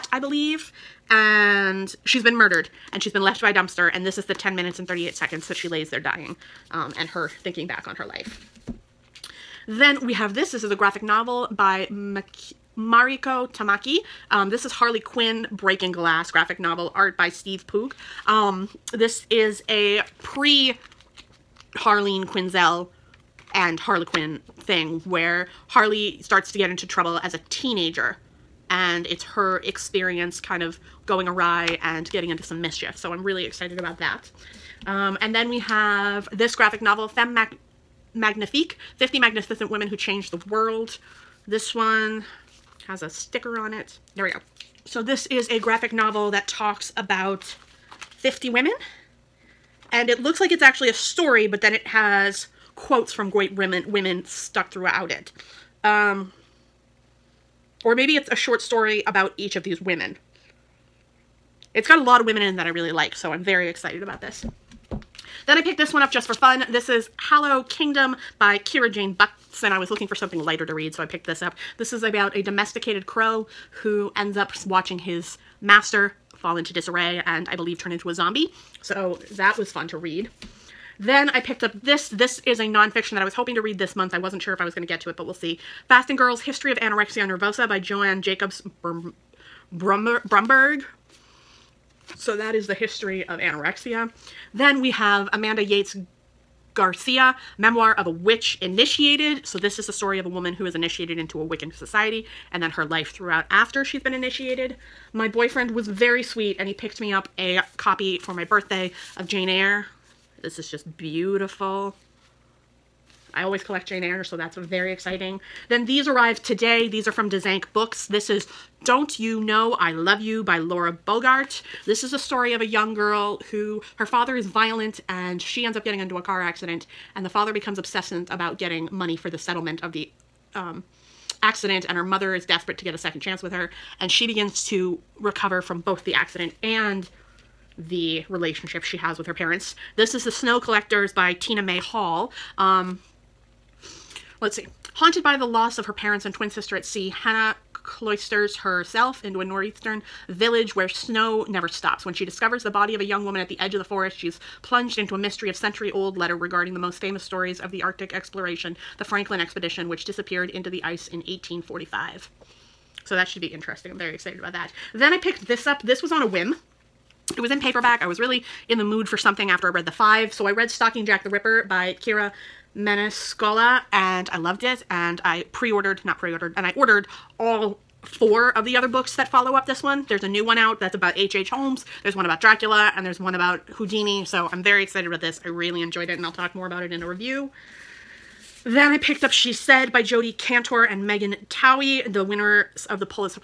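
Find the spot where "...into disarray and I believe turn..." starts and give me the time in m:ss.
1:16.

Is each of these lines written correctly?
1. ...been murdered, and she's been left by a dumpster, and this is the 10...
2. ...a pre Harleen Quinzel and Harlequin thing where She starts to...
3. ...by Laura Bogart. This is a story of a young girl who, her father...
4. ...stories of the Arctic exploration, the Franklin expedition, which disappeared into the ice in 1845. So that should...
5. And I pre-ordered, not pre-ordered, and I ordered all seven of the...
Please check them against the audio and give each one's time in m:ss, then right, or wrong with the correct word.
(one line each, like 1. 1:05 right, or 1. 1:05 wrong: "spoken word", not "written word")
1. 0:02 right
2. 0:19 wrong: "Harley", not "She"
3. 2:00 right
4. 2:37 right
5. 2:54 wrong: "four", not "seven".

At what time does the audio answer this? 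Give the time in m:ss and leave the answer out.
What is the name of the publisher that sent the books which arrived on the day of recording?
1:57.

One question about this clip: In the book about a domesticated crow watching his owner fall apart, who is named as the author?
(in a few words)
Kira Jane Buxton.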